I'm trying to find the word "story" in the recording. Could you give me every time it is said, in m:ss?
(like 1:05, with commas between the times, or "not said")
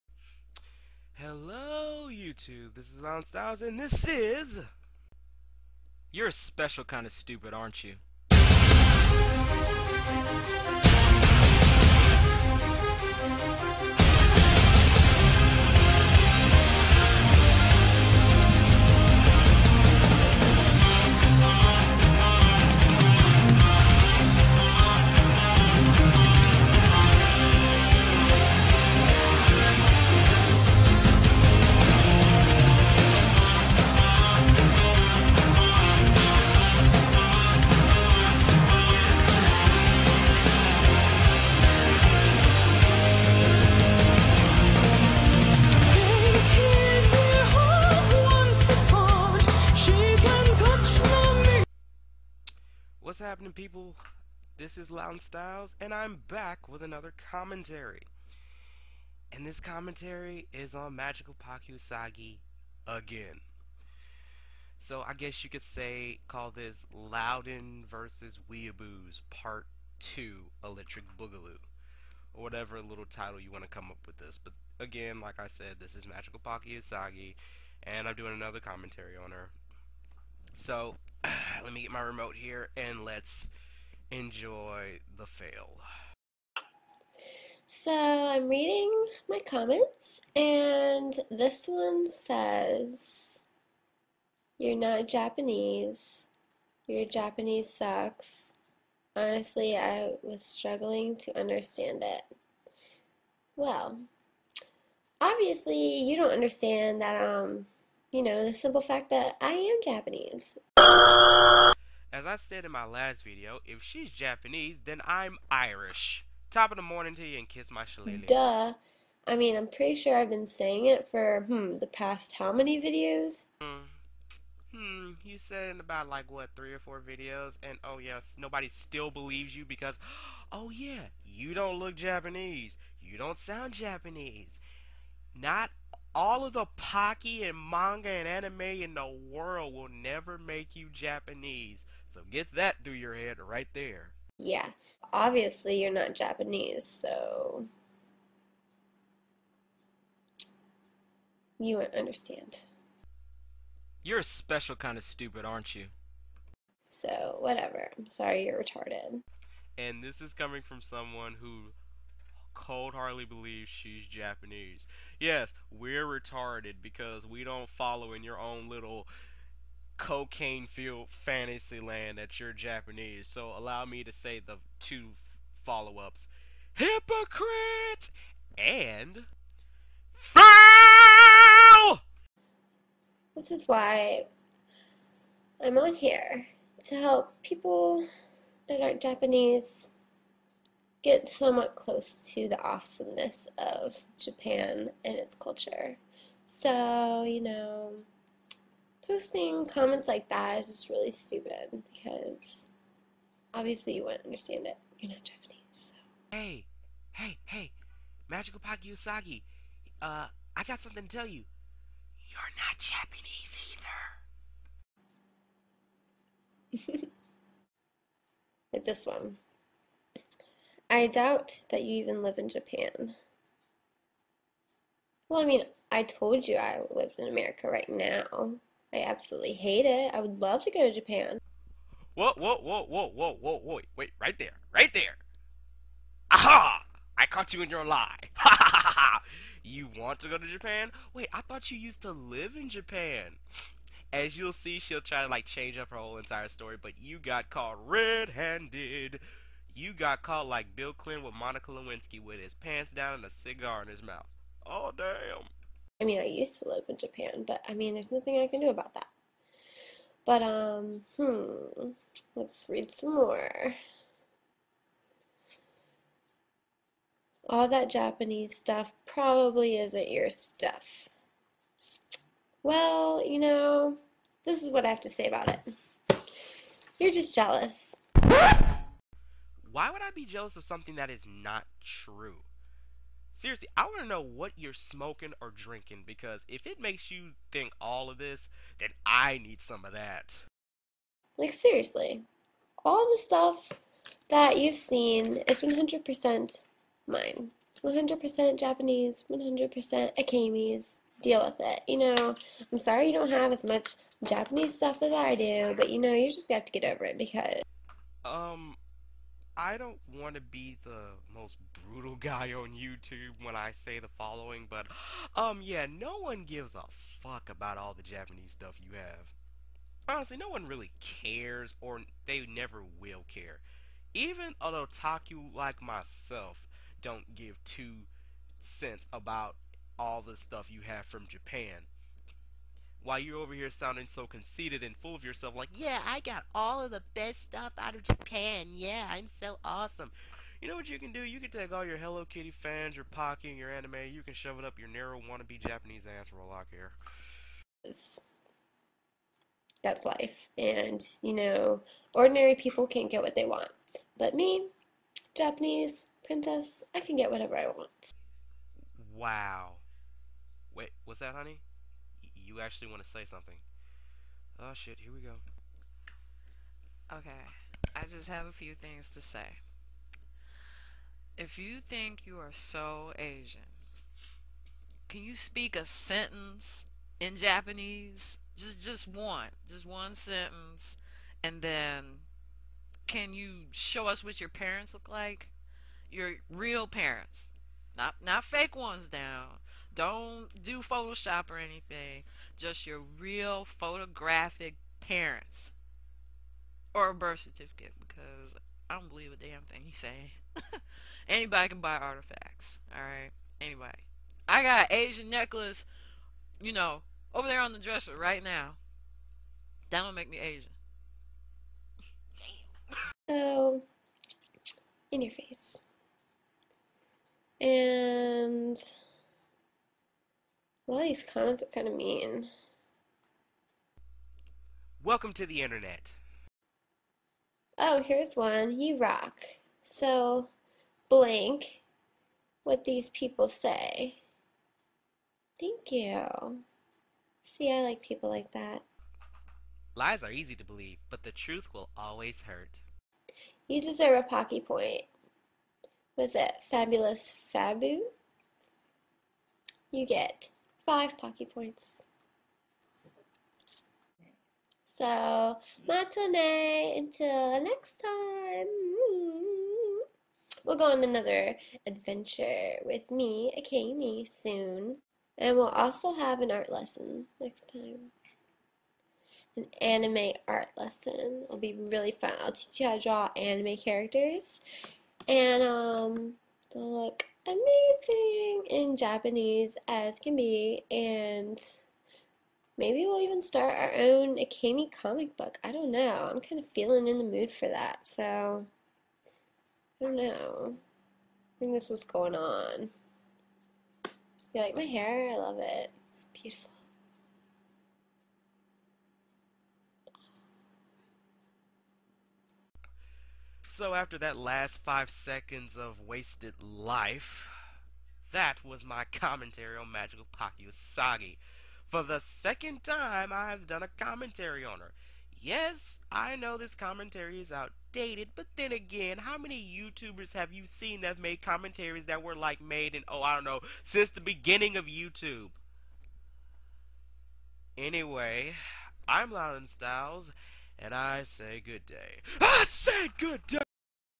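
4:06.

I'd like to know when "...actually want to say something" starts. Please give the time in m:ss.
6:02.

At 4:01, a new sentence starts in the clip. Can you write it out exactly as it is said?
Wait, I thought you used to live in Japan.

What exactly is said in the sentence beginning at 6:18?
Just just one, just one sentence, and then can you show us what your parents look like?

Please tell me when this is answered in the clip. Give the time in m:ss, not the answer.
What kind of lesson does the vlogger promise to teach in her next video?
7:49.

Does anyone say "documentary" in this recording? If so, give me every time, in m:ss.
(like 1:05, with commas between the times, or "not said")
not said.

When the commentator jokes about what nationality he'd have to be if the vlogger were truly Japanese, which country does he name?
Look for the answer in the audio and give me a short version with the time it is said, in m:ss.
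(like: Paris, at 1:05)
Irish, at 1:55.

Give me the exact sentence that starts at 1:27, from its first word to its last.
So I'm reading my comments, and this one says, You're not Japanese.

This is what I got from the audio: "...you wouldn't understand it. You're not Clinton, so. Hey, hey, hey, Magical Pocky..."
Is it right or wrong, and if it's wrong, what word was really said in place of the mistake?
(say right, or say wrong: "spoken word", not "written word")
wrong: "Japanese", not "Clinton".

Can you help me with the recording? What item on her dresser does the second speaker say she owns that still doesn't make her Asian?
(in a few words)
Asian necklace.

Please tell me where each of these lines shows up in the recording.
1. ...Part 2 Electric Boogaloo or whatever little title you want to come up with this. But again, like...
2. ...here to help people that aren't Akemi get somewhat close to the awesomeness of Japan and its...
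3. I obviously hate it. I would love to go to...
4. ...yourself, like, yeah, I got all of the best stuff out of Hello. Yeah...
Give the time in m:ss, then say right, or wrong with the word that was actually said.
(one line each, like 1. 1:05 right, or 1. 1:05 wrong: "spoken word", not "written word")
1. 1:09 right
2. 3:05 wrong: "Japanese", not "Akemi"
3. 3:48 wrong: "absolutely", not "obviously"
4. 5:35 wrong: "Japan", not "Hello".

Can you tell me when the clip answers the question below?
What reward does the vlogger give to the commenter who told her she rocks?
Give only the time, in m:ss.
7:24.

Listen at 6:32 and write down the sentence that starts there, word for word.
Just your real photographic parents or a birth certificate because I don't believe a damn thing he's saying.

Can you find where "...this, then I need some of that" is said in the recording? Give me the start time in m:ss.
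4:48.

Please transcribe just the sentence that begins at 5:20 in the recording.
Honestly, no one really cares or they never will care.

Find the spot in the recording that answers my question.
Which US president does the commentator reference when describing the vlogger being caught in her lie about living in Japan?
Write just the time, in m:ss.
4:10.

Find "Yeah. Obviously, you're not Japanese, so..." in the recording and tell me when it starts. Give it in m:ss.
2:24.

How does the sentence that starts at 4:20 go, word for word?
But, um, hmm, let's read some more.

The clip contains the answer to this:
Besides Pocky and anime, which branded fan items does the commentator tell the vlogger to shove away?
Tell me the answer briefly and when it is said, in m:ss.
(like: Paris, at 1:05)
Hello Kitty, at 5:41.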